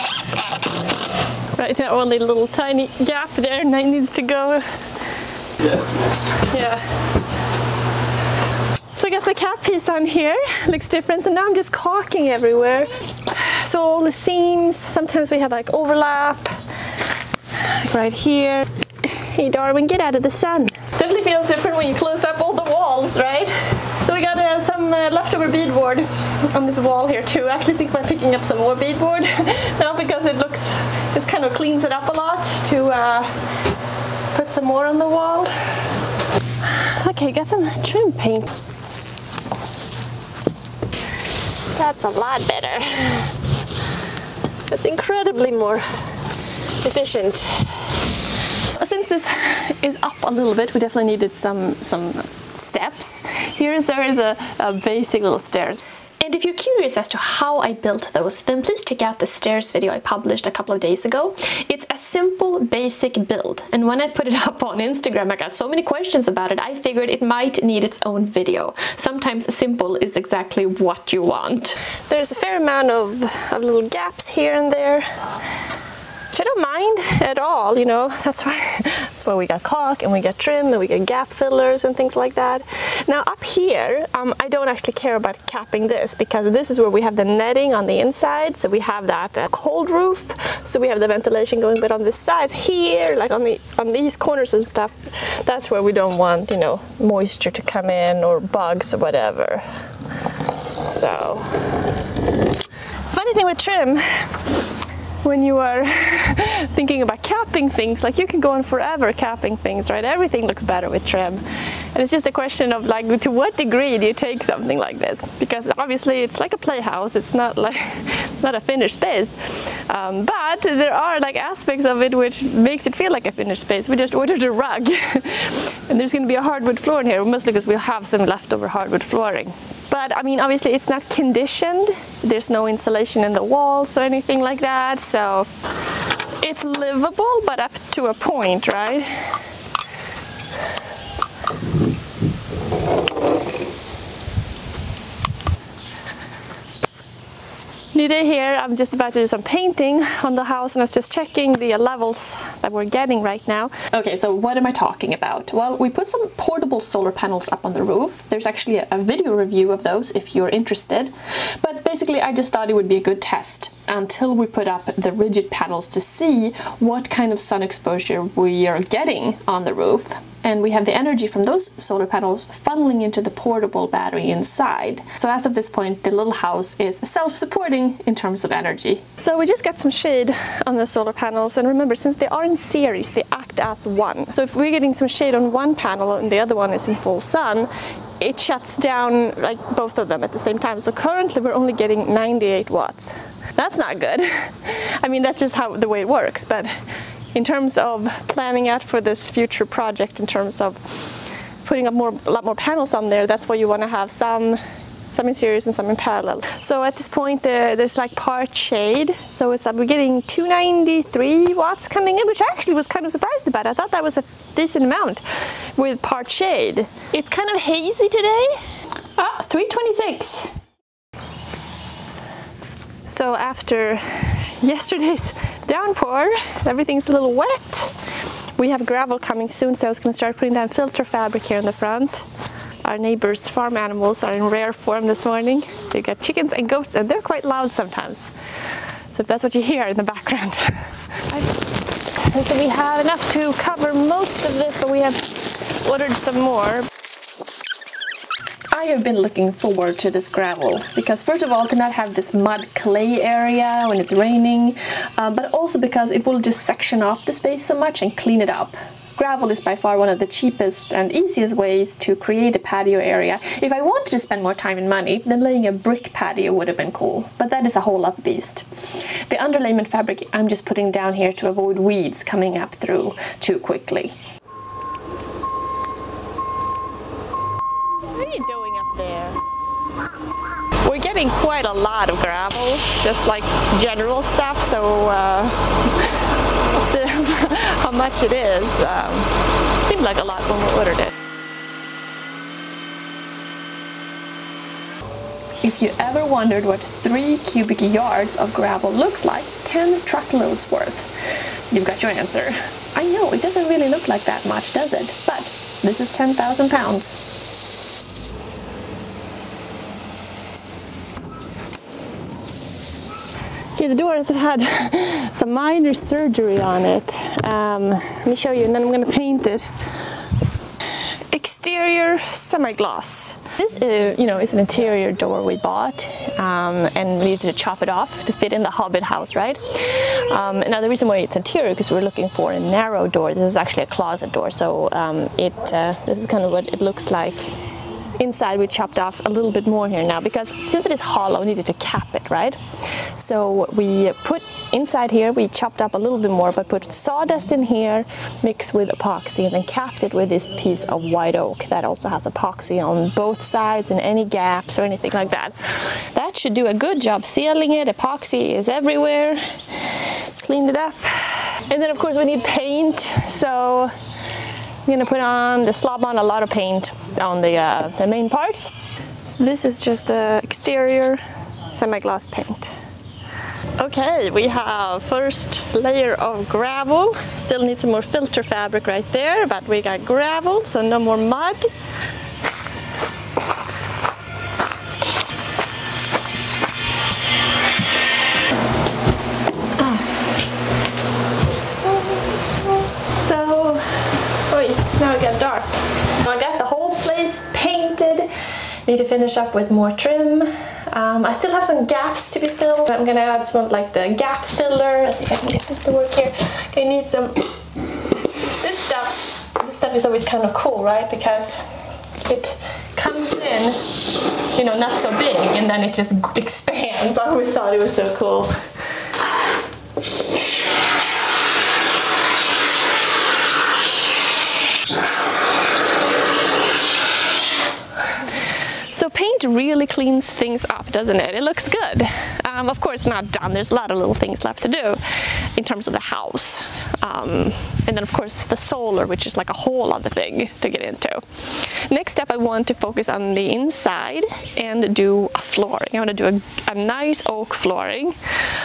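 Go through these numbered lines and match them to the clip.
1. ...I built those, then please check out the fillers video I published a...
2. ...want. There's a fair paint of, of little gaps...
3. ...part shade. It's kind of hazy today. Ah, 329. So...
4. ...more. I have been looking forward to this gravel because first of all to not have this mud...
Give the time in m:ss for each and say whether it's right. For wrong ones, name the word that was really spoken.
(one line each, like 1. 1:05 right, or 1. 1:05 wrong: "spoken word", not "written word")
1. 0:57 wrong: "stairs", not "fillers"
2. 1:11 wrong: "amount", not "paint"
3. 3:36 wrong: "326", not "329"
4. 4:06 right.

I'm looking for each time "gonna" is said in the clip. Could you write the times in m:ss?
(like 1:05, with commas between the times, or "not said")
2:06, 5:18, 6:04, 6:43.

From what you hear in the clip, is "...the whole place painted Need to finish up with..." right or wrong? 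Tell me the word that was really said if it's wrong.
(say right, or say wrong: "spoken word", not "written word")
right.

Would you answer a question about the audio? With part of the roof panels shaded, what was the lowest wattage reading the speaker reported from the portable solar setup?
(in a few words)
98 watts.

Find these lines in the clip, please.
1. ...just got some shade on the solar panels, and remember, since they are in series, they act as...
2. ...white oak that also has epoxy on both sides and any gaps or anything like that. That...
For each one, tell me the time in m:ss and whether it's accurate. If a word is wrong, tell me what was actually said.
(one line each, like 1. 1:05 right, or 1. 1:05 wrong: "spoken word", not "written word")
1. 2:59 right
2. 5:51 right.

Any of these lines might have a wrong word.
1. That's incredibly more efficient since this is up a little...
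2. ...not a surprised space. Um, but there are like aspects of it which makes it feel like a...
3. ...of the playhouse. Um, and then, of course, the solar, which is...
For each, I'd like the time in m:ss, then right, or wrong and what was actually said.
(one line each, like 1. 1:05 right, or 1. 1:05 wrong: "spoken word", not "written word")
1. 0:44 right
2. 1:58 wrong: "finished", not "surprised"
3. 7:15 wrong: "house", not "playhouse".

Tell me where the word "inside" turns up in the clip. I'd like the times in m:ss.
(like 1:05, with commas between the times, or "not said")
1:27, 2:54, 5:38, 5:44, 7:23.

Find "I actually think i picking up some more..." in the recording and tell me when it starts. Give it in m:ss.
0:27.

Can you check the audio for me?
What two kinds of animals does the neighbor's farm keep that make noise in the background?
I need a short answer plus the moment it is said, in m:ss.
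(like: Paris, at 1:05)
chickens and goats, at 3:56.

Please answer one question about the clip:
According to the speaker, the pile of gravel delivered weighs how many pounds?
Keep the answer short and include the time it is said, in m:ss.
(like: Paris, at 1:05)
10,000 pounds, at 5:06.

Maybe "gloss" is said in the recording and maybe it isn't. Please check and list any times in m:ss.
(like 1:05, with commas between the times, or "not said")
5:22, 6:11.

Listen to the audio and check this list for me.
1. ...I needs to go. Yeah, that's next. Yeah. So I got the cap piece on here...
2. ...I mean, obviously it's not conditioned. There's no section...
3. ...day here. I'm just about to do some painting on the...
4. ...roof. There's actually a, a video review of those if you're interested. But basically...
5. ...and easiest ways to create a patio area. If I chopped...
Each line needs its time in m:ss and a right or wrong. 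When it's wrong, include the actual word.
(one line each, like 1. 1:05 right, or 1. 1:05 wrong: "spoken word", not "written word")
1. 0:03 right
2. 2:10 wrong: "insulation", not "section"
3. 2:28 right
4. 2:37 right
5. 4:20 wrong: "wanted", not "chopped".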